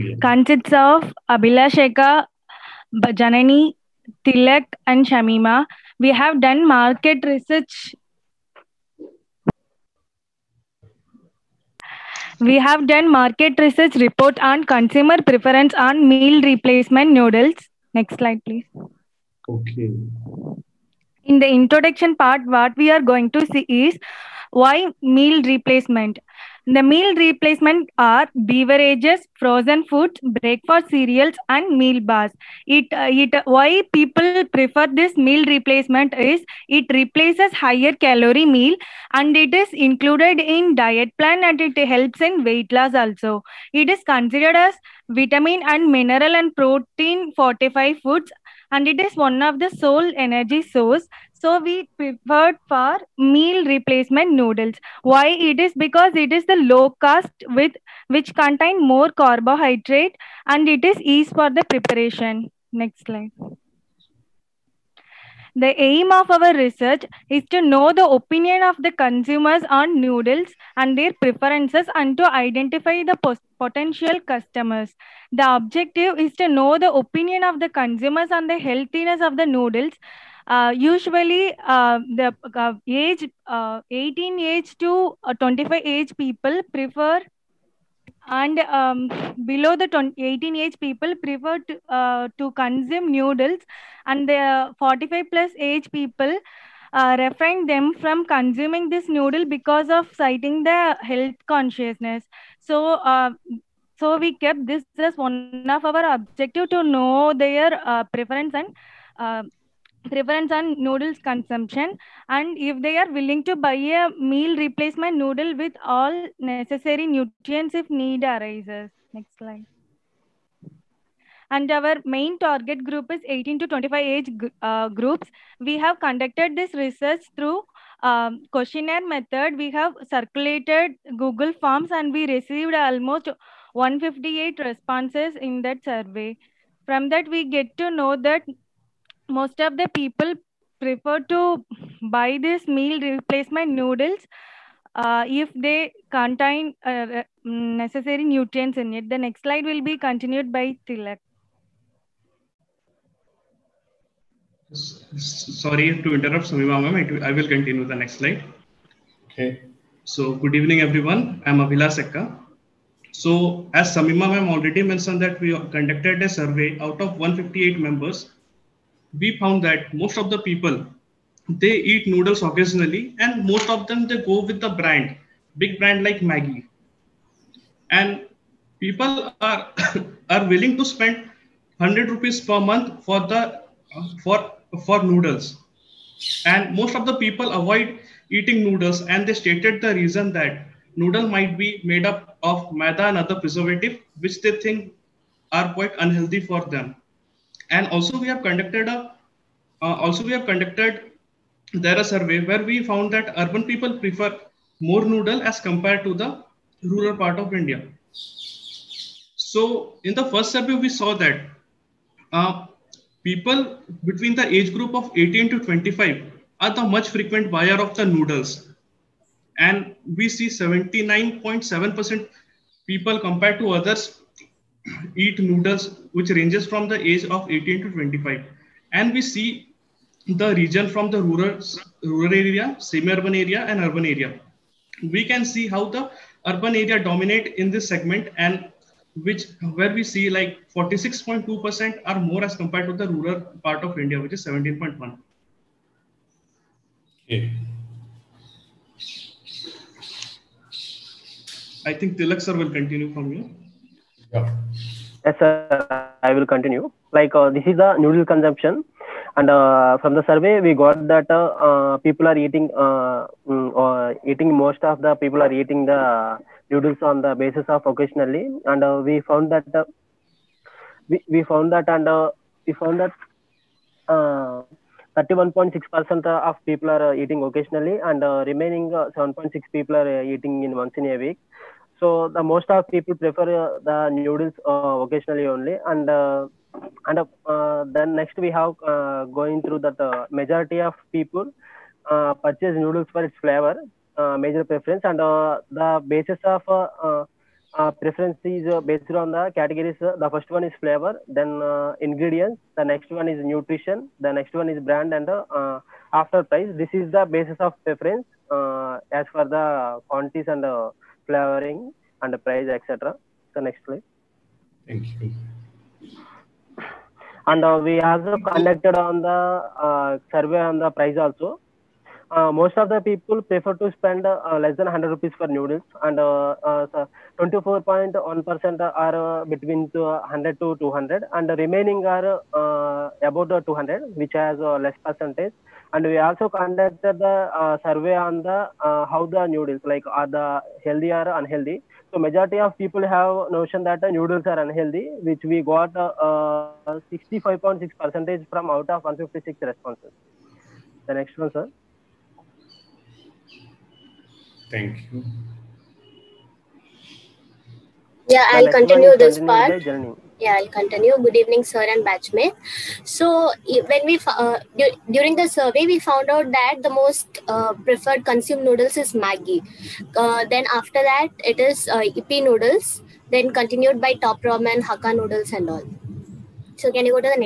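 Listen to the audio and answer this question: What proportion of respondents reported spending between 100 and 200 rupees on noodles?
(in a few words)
24.1%.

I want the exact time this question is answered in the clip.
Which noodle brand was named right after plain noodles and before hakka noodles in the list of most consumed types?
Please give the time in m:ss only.
6:14.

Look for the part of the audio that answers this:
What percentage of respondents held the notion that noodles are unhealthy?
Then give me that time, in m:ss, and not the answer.
5:47.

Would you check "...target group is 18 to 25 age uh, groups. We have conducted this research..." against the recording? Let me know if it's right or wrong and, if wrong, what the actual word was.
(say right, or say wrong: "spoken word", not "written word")
right.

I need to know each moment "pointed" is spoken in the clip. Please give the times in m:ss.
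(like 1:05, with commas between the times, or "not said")
not said.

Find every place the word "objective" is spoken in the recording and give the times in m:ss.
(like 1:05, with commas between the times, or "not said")
1:15, 1:46.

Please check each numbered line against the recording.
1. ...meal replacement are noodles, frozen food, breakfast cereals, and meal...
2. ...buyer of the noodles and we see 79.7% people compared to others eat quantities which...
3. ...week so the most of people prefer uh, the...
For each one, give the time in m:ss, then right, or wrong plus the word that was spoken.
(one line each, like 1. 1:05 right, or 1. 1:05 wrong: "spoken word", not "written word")
1. 0:26 wrong: "beverages", not "noodles"
2. 3:37 wrong: "noodles", not "quantities"
3. 4:41 right.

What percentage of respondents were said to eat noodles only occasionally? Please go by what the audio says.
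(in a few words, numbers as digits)
31.6%.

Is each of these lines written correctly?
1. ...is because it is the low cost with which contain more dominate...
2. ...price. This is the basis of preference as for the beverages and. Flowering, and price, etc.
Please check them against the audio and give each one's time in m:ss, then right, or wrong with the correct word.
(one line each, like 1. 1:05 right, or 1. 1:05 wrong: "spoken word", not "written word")
1. 0:55 wrong: "carbohydrate", not "dominate"
2. 5:06 wrong: "quantities", not "beverages".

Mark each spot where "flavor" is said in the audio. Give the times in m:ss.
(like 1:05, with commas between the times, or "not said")
4:53, 5:00.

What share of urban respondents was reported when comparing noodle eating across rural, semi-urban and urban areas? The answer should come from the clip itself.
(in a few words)
46.2%.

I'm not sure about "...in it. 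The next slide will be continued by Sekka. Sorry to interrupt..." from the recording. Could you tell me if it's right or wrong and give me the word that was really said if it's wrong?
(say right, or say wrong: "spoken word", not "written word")
wrong: "Thilak", not "Sekka".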